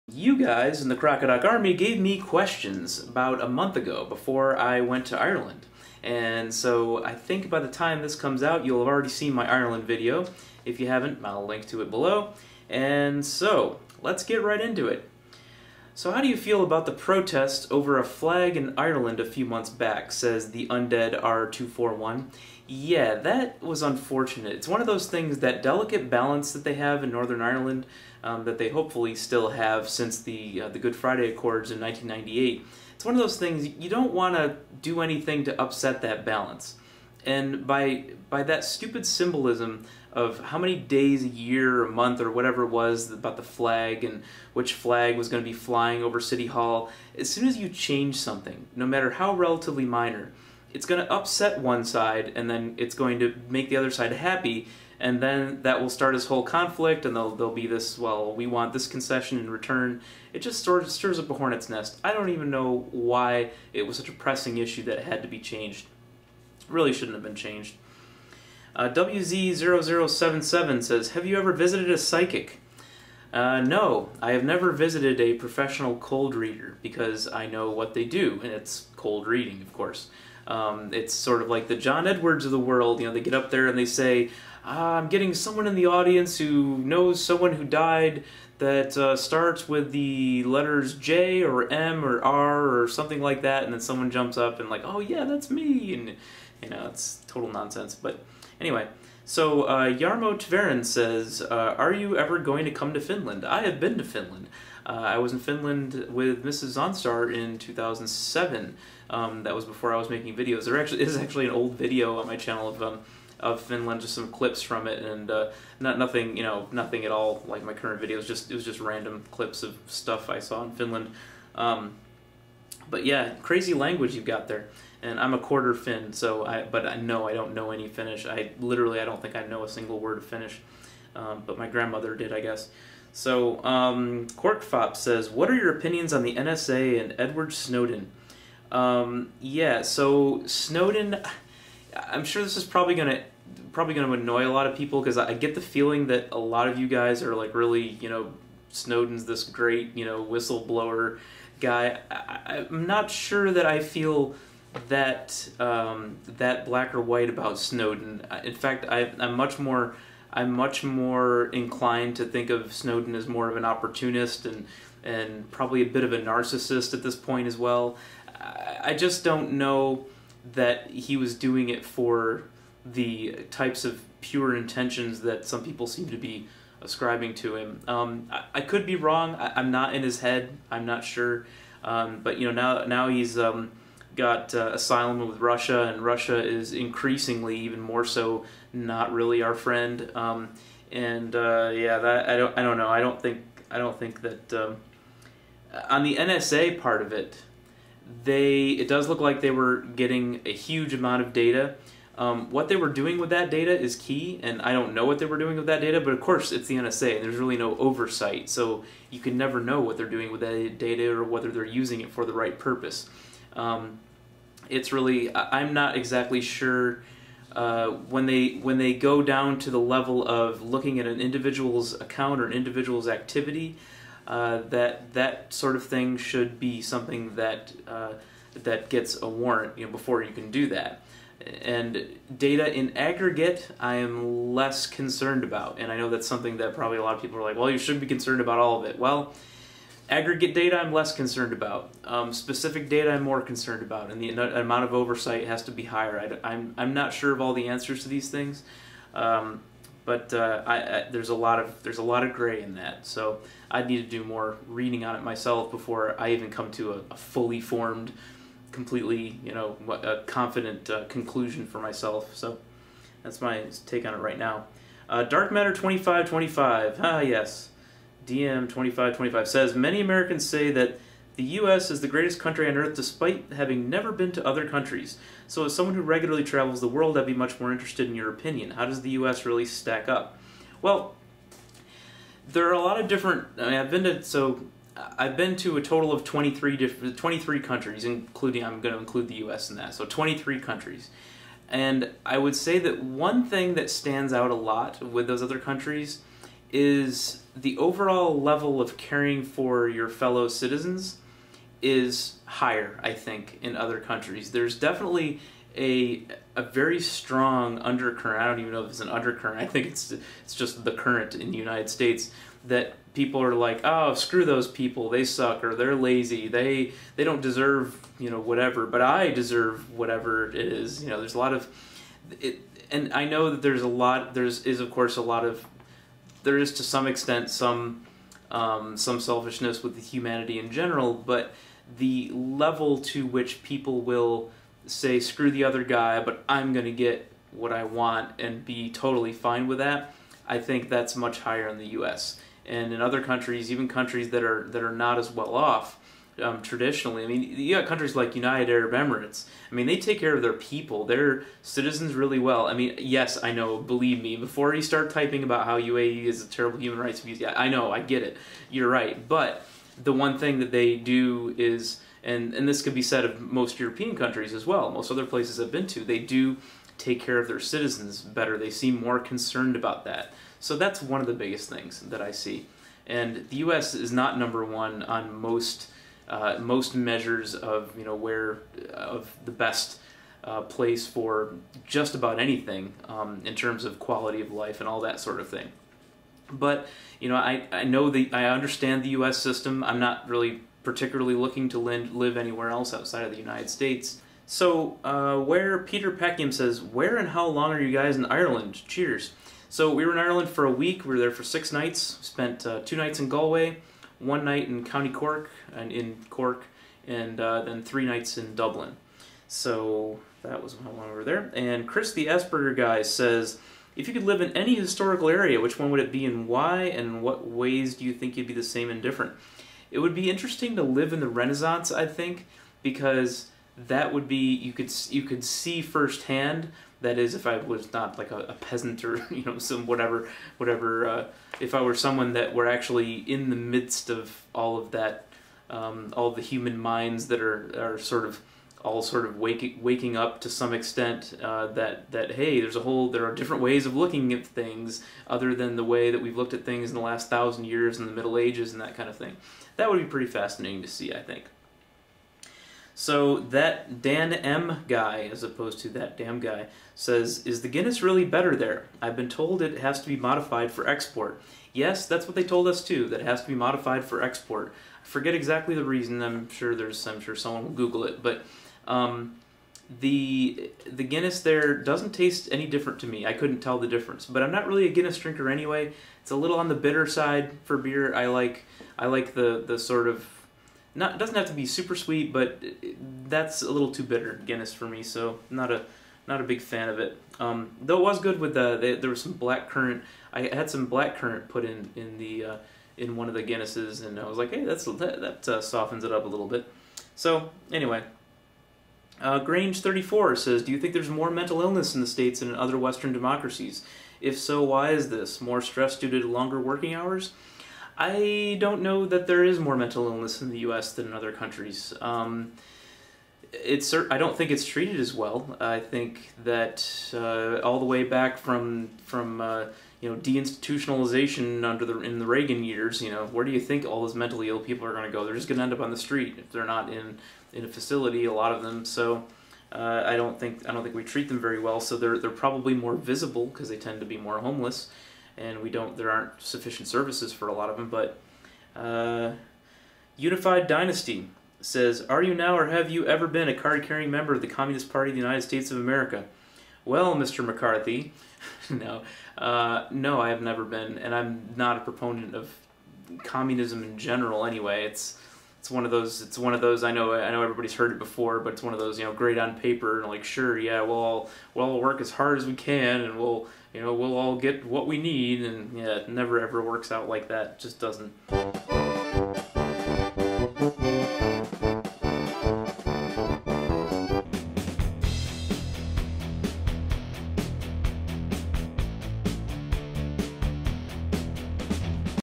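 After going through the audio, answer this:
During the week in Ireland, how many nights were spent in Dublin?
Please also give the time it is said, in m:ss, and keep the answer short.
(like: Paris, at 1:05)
3, at 6:47.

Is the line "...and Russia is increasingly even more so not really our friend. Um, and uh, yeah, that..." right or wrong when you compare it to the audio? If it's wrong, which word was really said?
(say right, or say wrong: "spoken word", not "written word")
right.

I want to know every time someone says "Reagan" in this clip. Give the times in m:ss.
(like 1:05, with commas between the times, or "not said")
8:42.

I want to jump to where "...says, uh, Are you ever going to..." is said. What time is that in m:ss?
1:40.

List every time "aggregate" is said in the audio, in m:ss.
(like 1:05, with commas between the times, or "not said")
3:52, 4:00.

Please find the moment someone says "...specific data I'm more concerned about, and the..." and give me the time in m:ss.
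4:02.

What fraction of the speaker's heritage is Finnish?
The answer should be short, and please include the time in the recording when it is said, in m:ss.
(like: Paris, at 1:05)
a quarter, at 2:05.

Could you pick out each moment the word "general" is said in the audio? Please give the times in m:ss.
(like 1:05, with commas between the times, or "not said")
5:30, 9:13.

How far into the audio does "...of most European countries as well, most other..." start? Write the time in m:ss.
6:03.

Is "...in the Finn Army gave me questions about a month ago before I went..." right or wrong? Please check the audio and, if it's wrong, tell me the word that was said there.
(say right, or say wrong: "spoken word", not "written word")
wrong: "Crocodoc", not "Finn".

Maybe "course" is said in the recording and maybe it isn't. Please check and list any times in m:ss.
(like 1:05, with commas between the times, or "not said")
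1:19, 3:26, 5:24.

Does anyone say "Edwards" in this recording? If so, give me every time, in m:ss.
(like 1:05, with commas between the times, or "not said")
1:22, 2:17.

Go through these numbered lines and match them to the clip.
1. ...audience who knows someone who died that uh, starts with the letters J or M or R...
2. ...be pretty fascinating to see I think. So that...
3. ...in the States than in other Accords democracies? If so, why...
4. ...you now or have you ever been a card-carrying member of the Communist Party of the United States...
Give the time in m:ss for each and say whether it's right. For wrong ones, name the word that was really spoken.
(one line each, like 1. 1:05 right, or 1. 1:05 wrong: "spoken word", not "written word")
1. 1:25 right
2. 7:29 right
3. 8:21 wrong: "Western", not "Accords"
4. 9:02 right.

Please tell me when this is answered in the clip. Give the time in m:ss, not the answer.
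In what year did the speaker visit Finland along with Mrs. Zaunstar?
1:47.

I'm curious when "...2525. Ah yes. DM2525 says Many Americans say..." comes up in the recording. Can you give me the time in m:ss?
4:25.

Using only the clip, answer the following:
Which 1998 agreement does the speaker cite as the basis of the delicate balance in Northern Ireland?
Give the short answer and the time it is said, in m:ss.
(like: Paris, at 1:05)
Good Friday Accords, at 0:30.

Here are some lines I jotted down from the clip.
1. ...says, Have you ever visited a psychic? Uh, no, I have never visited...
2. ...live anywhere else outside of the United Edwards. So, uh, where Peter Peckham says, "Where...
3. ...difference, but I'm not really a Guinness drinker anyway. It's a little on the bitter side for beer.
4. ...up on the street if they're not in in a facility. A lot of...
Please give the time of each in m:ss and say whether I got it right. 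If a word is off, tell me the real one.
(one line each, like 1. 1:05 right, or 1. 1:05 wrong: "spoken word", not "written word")
1. 1:10 right
2. 6:31 wrong: "States", not "Edwards"
3. 7:53 right
4. 8:45 right.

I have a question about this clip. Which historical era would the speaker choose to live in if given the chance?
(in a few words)
the Renaissance.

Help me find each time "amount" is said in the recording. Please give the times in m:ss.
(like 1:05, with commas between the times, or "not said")
3:20, 4:04.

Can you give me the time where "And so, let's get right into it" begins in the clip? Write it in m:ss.
0:12.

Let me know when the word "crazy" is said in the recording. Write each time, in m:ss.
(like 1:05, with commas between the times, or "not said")
2:03.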